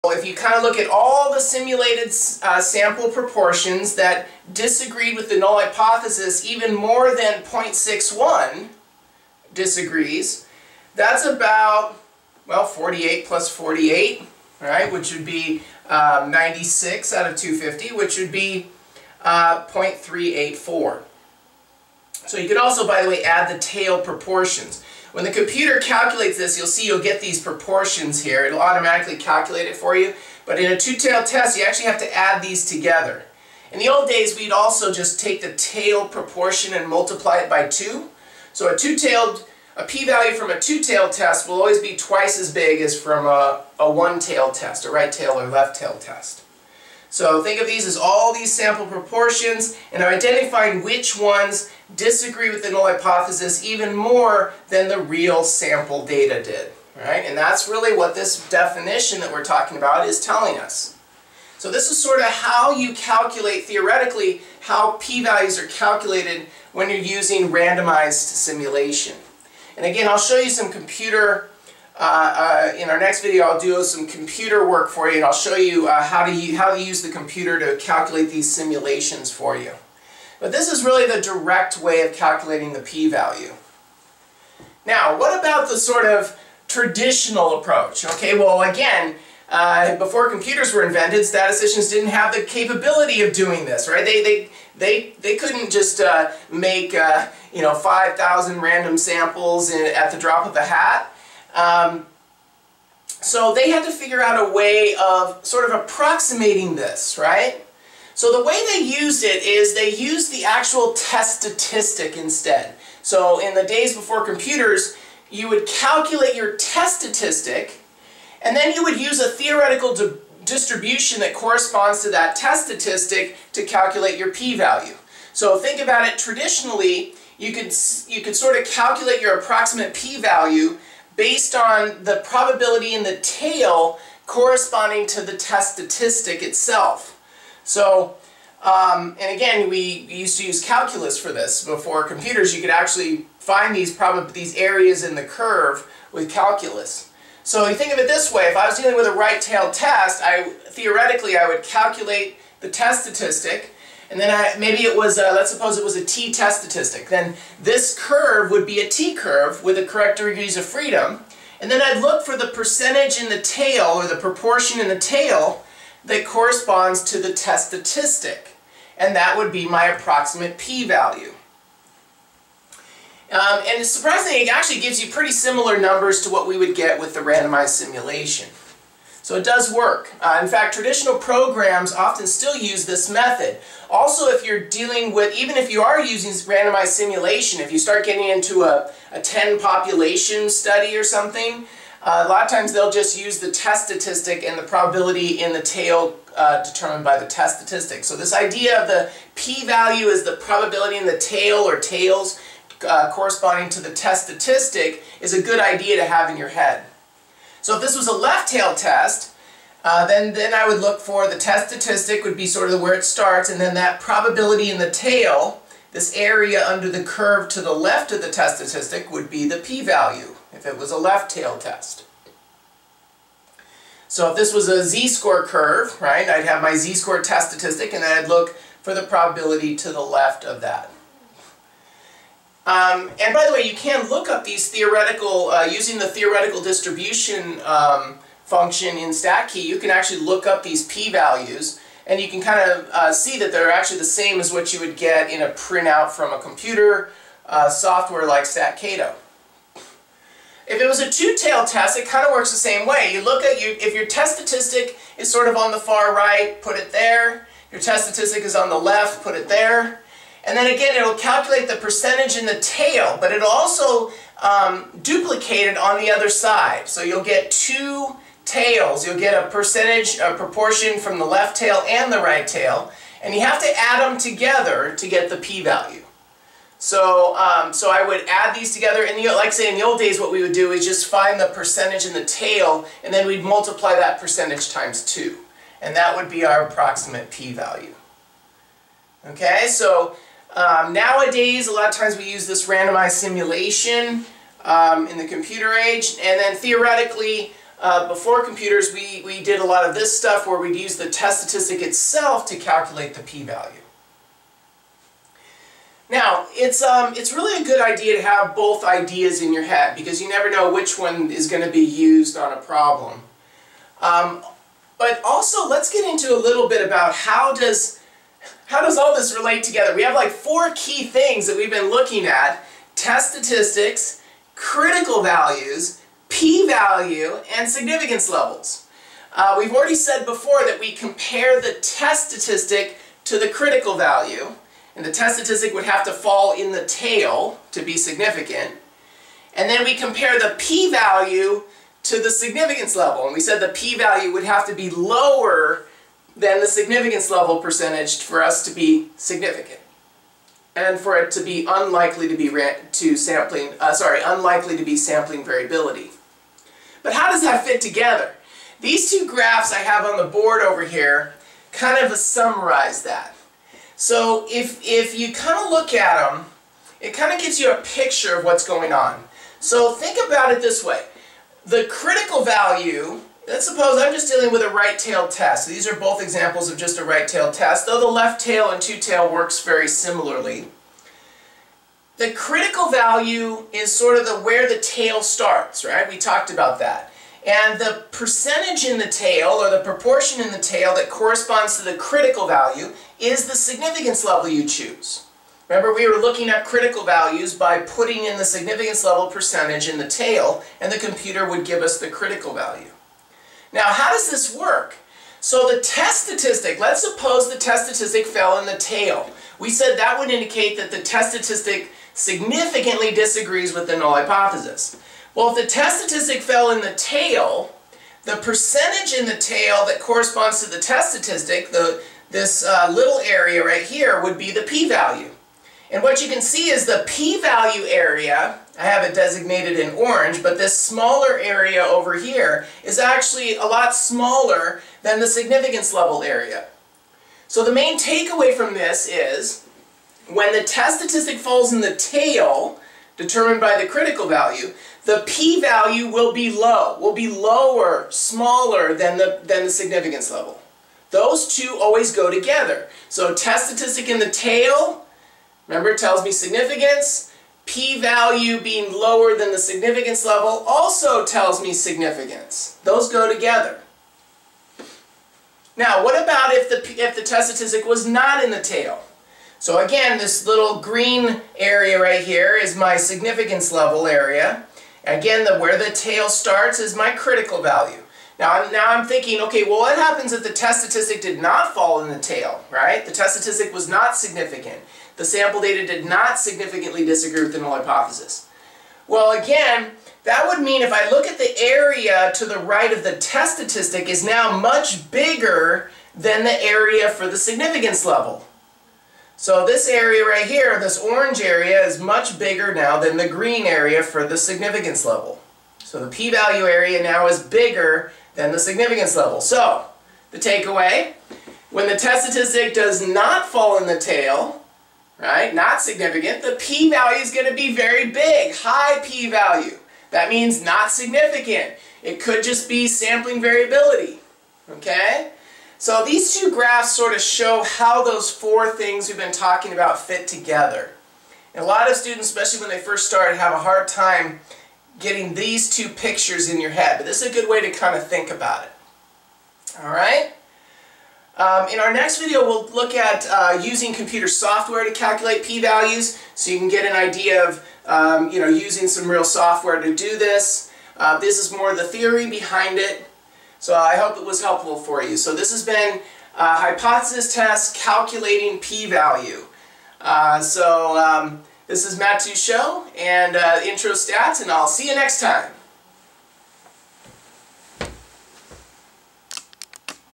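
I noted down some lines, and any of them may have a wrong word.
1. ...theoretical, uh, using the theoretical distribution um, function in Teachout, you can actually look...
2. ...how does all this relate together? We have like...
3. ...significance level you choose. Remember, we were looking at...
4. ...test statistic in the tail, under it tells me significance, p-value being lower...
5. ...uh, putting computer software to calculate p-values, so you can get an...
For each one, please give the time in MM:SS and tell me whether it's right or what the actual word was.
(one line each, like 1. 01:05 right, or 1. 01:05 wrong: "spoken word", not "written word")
1. 03:54 wrong: "StatKey", not "Teachout"
2. 05:18 right
3. 06:33 right
4. 07:33 wrong: "remember", not "under"
5. 09:03 wrong: "using", not "putting".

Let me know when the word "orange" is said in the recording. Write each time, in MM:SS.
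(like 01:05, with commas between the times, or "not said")
07:09, 08:20.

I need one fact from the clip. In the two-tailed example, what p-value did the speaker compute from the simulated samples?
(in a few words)
0.384.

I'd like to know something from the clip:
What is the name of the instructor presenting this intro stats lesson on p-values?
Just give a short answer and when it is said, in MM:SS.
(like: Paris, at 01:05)
Matt Teachout, at 09:21.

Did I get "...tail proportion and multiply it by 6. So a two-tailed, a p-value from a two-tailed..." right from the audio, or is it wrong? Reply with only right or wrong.
wrong.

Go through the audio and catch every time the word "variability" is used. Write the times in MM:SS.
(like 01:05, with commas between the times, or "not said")
05:55, 08:43.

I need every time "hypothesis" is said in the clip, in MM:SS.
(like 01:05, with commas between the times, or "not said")
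00:05, 00:52, 06:54, 08:07, 09:16.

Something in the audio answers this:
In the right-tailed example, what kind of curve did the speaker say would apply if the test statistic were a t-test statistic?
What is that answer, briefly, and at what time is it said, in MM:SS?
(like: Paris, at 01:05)
t-curve, at 02:38.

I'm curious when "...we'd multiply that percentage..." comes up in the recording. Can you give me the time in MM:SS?
04:43.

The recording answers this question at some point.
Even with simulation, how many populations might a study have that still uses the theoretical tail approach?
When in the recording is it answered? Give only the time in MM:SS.
03:09.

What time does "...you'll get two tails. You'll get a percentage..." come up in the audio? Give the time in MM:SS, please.
04:27.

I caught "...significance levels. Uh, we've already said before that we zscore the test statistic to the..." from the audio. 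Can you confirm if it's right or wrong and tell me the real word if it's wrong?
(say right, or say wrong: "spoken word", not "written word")
wrong: "compare", not "zscore".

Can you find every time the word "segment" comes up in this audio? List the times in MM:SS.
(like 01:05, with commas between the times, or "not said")
not said.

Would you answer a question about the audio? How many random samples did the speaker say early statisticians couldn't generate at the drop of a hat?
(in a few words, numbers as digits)
5,000.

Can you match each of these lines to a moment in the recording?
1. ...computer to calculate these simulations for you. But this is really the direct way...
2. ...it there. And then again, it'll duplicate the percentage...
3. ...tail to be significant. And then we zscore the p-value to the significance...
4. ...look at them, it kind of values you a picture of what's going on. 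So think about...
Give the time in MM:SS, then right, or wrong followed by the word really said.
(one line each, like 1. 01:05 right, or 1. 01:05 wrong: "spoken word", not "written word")
1. 01:17 right
2. 04:19 wrong: "calculate", not "duplicate"
3. 05:36 wrong: "compare", not "zscore"
4. 06:05 wrong: "gives", not "values".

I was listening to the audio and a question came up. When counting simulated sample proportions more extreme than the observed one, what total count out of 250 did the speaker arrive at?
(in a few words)
96.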